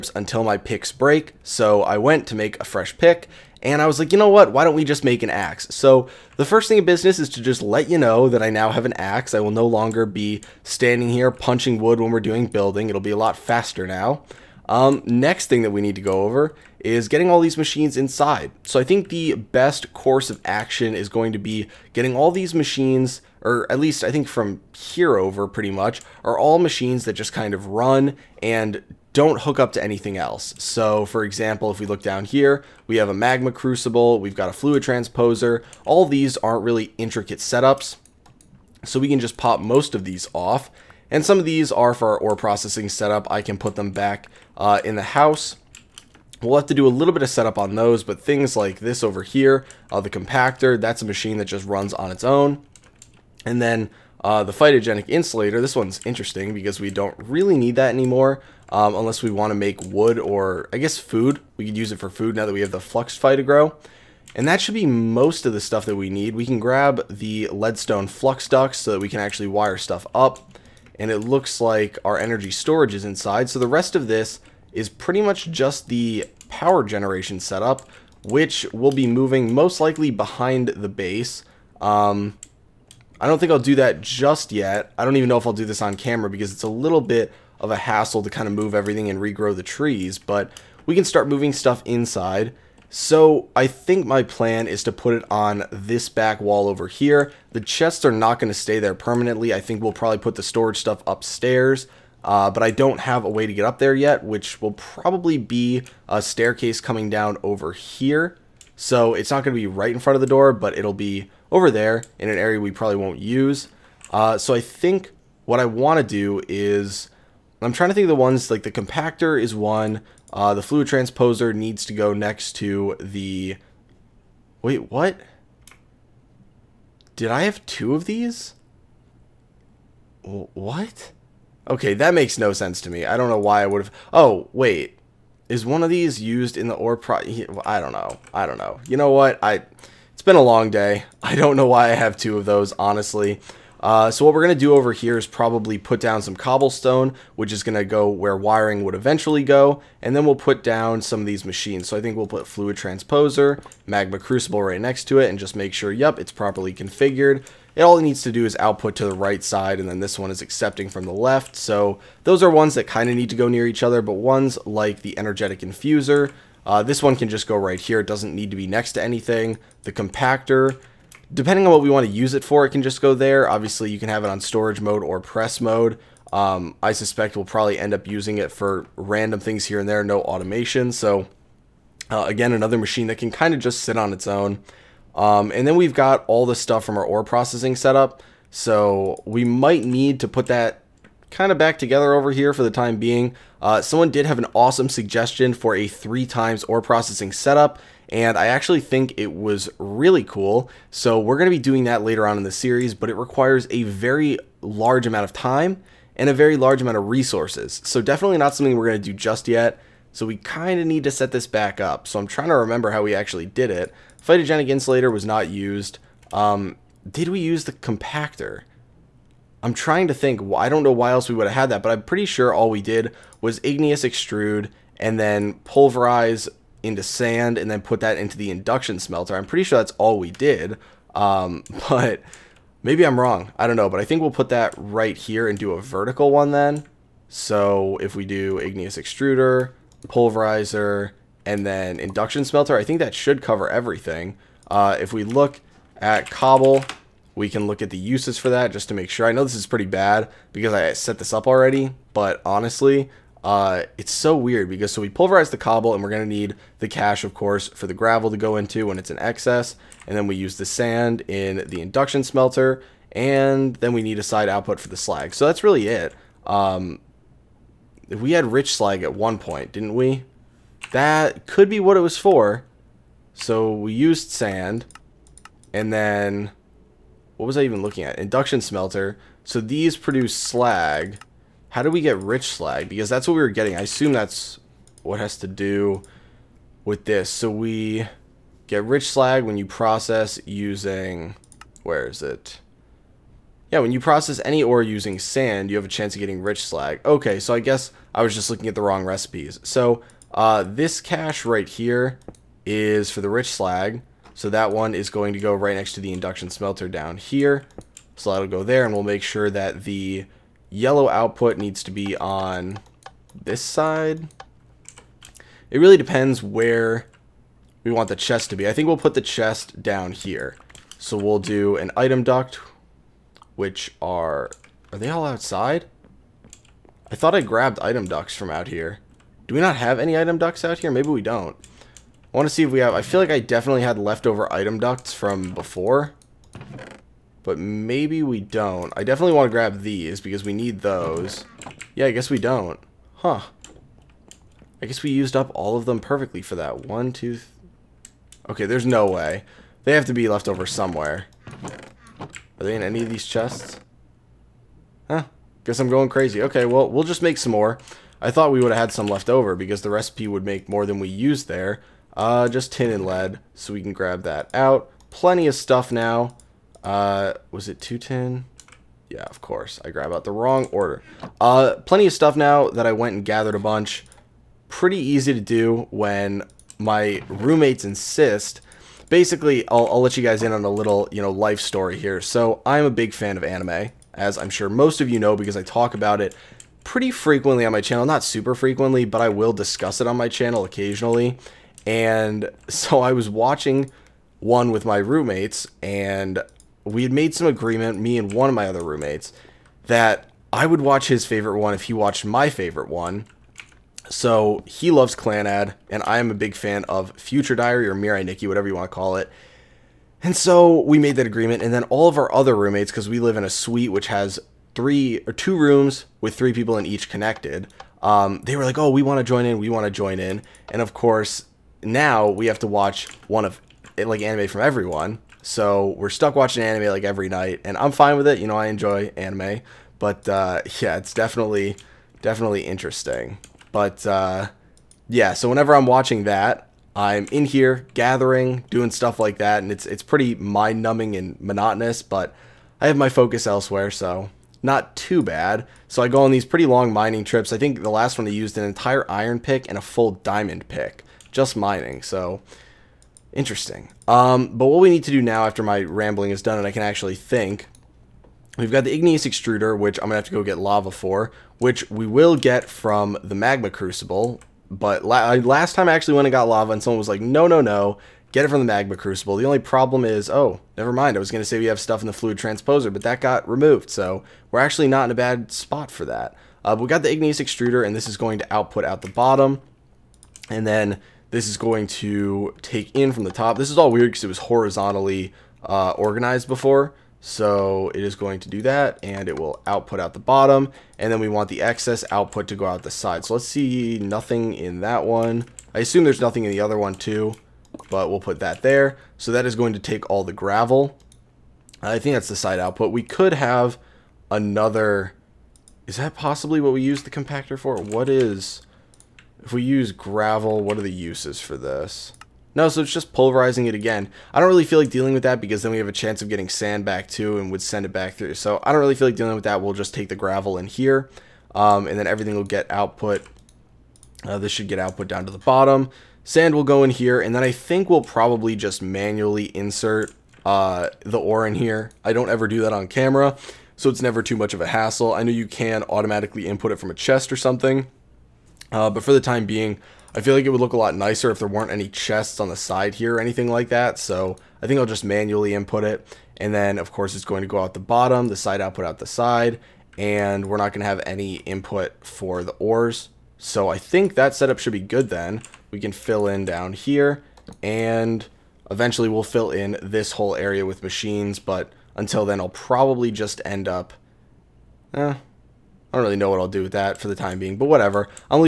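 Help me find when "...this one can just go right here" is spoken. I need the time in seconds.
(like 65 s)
166 s.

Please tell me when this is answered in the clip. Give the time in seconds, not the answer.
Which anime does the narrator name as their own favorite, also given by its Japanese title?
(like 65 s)
407 s.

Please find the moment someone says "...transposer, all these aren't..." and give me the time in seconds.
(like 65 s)
34 s.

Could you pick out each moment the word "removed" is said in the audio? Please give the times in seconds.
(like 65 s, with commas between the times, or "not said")
473 s.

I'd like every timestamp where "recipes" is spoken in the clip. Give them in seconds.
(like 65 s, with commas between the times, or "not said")
299 s, 359 s.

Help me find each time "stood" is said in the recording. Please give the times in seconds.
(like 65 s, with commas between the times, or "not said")
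not said.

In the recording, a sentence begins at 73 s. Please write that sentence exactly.
So the rest of this is pretty much just the power generation setup, which will be moving most likely behind the base.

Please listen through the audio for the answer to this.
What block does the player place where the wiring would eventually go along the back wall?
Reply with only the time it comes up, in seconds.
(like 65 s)
146 s.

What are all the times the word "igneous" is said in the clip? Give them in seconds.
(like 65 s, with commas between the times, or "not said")
223 s, 238 s, 458 s, 477 s.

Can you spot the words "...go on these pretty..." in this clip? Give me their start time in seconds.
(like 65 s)
446 s.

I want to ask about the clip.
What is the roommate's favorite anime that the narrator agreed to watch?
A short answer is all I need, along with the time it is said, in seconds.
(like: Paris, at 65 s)
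Clannad, at 405 s.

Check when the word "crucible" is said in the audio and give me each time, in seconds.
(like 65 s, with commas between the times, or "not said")
33 s, 154 s, 463 s, 468 s.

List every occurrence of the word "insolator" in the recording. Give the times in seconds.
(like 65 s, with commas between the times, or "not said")
55 s, 214 s.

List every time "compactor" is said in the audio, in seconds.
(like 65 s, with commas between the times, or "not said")
50 s, 118 s, 169 s, 217 s, 507 s.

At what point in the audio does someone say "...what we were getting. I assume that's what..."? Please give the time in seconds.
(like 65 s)
283 s.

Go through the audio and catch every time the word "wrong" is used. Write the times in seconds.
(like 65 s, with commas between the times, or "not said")
233 s, 298 s, 370 s.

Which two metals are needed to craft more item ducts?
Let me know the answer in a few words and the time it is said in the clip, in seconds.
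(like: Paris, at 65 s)
Tin and lead, at 362 s.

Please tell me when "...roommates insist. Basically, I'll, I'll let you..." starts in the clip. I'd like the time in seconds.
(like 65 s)
377 s.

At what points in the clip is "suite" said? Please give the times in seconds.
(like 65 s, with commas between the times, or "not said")
413 s.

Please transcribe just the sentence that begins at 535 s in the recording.
I know you can automatically input it from a chest or something.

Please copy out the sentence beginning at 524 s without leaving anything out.
Uh, this should get output down to the bottom.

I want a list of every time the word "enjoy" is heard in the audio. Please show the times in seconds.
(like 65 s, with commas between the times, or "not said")
428 s.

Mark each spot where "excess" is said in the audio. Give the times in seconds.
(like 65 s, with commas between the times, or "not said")
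259 s, 491 s.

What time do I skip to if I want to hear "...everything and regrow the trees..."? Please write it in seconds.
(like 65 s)
88 s.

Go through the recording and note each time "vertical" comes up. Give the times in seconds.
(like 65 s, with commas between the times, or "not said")
235 s.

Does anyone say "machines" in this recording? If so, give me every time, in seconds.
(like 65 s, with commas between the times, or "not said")
17 s, 22 s, 26 s, 51 s, 151 s, 182 s, 560 s.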